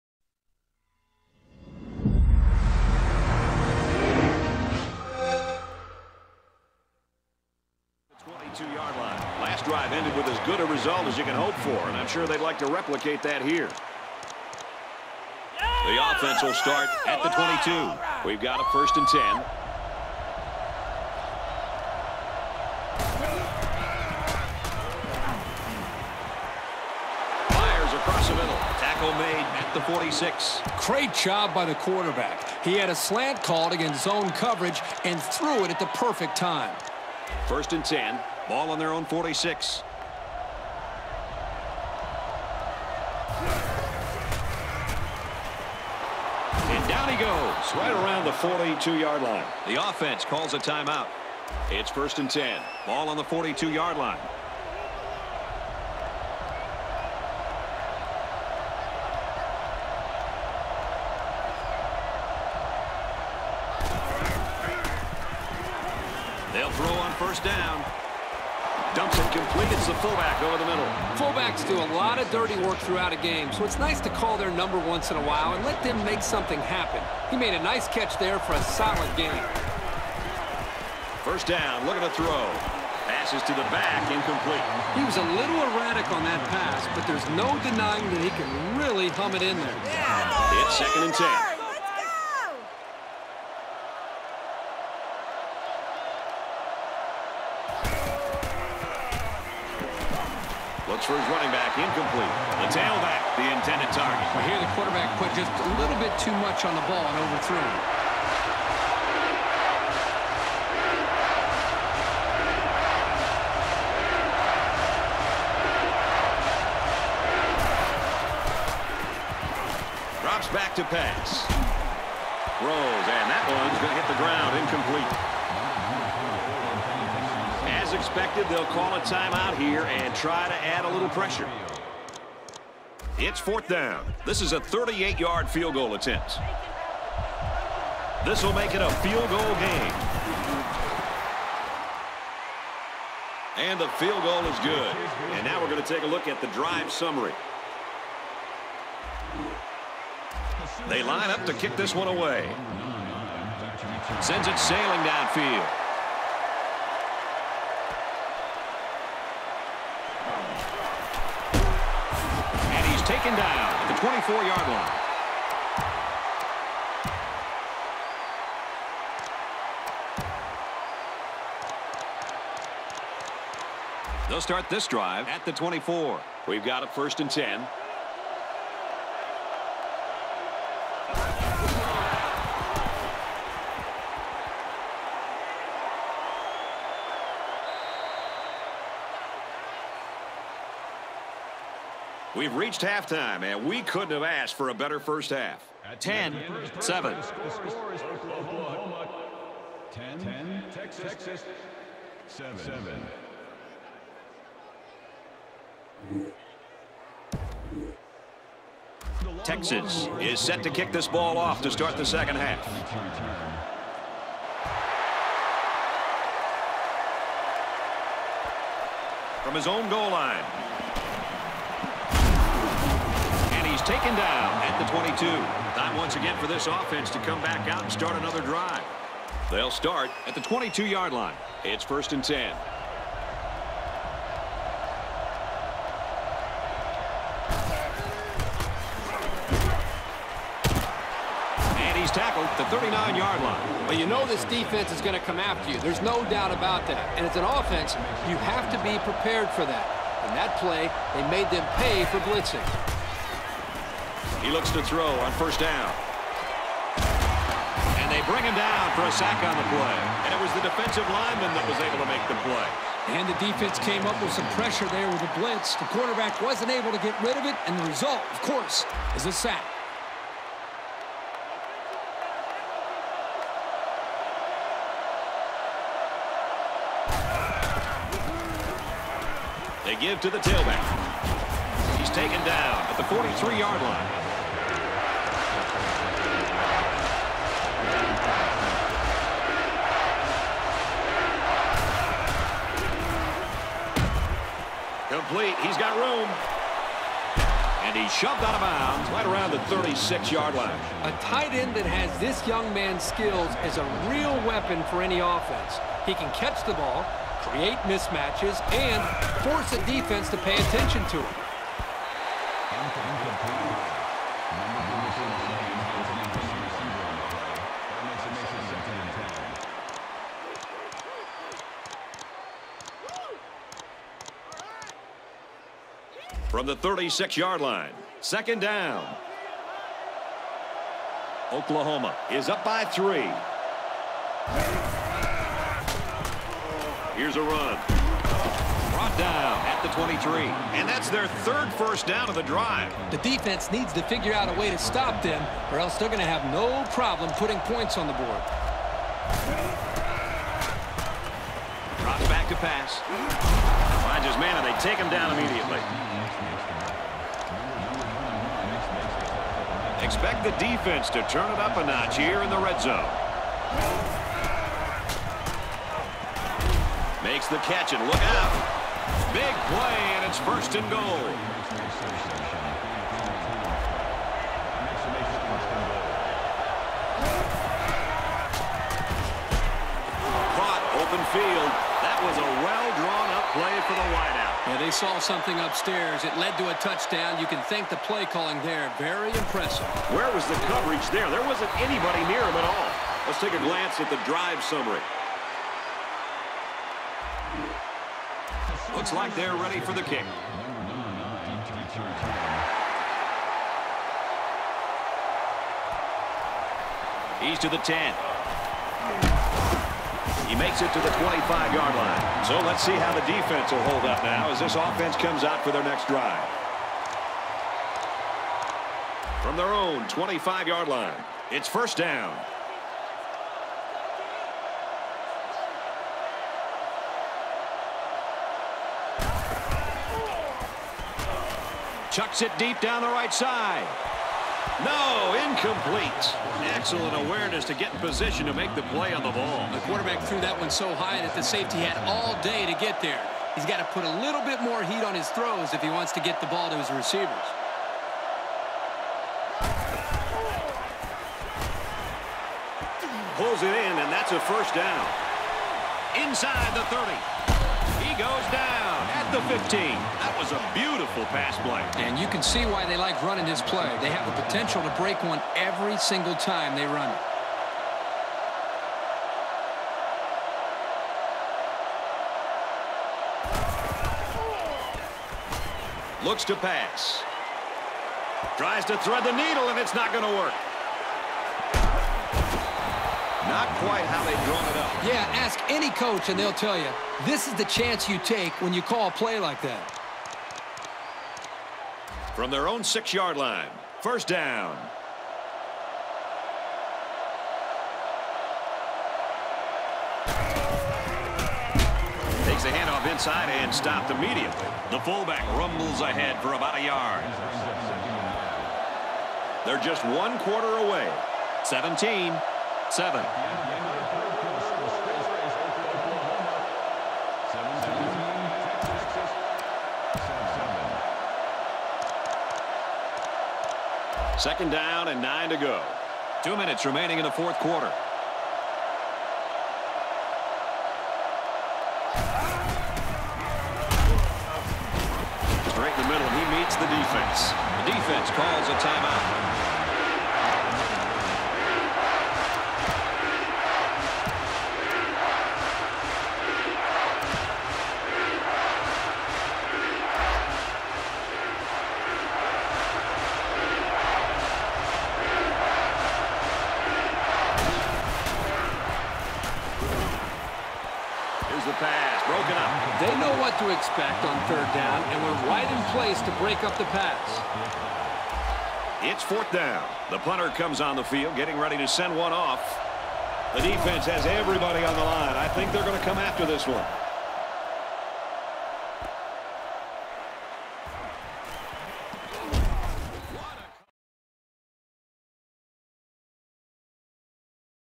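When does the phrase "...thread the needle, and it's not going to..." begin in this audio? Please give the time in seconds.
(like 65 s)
478 s.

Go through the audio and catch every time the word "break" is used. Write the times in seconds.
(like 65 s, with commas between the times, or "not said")
464 s, 566 s.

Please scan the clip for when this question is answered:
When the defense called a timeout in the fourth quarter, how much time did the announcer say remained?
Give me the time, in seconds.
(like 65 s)
526 s.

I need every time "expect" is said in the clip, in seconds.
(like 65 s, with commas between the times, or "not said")
360 s, 563 s.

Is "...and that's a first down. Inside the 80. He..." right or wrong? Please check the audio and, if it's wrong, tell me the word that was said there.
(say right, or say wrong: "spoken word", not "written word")
wrong: "30", not "80".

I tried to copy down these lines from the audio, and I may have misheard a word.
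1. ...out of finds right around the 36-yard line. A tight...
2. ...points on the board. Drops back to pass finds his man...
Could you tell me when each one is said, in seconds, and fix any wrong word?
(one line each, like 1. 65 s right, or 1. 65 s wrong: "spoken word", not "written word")
1. 298 s wrong: "bounds", not "finds"
2. 347 s right.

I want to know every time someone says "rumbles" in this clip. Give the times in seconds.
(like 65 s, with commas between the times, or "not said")
505 s.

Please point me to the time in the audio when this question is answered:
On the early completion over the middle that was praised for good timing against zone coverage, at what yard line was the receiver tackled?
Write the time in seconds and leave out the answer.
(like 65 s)
28 s.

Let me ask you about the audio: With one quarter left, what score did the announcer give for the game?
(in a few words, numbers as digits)
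17-7.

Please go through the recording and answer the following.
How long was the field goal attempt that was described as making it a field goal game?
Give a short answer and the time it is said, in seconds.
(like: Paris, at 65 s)
38 yards, at 134 s.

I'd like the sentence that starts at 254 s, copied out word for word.
He looks to throw on first down.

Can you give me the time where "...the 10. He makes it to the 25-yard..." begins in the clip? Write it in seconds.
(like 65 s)
407 s.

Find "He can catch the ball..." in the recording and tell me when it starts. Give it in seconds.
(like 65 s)
306 s.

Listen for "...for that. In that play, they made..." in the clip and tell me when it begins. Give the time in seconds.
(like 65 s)
249 s.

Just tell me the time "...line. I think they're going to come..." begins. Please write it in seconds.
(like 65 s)
575 s.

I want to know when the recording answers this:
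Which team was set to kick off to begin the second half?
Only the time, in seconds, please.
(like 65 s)
209 s.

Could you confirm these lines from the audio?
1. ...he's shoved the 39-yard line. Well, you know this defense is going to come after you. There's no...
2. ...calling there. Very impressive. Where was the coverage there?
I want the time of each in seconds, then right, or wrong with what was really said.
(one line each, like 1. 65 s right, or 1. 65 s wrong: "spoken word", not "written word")
1. 241 s wrong: "tackled", not "shoved"
2. 388 s right.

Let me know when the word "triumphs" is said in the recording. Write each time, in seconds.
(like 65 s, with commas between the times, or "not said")
not said.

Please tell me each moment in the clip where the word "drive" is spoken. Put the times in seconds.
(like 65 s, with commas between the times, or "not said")
9 s, 146 s, 174 s, 228 s, 342 s, 394 s, 416 s.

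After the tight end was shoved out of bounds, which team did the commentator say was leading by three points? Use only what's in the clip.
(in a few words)
Oklahoma.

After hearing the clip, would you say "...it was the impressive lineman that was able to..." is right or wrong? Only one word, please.
wrong.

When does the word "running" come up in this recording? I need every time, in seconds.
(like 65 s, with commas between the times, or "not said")
101 s, 463 s.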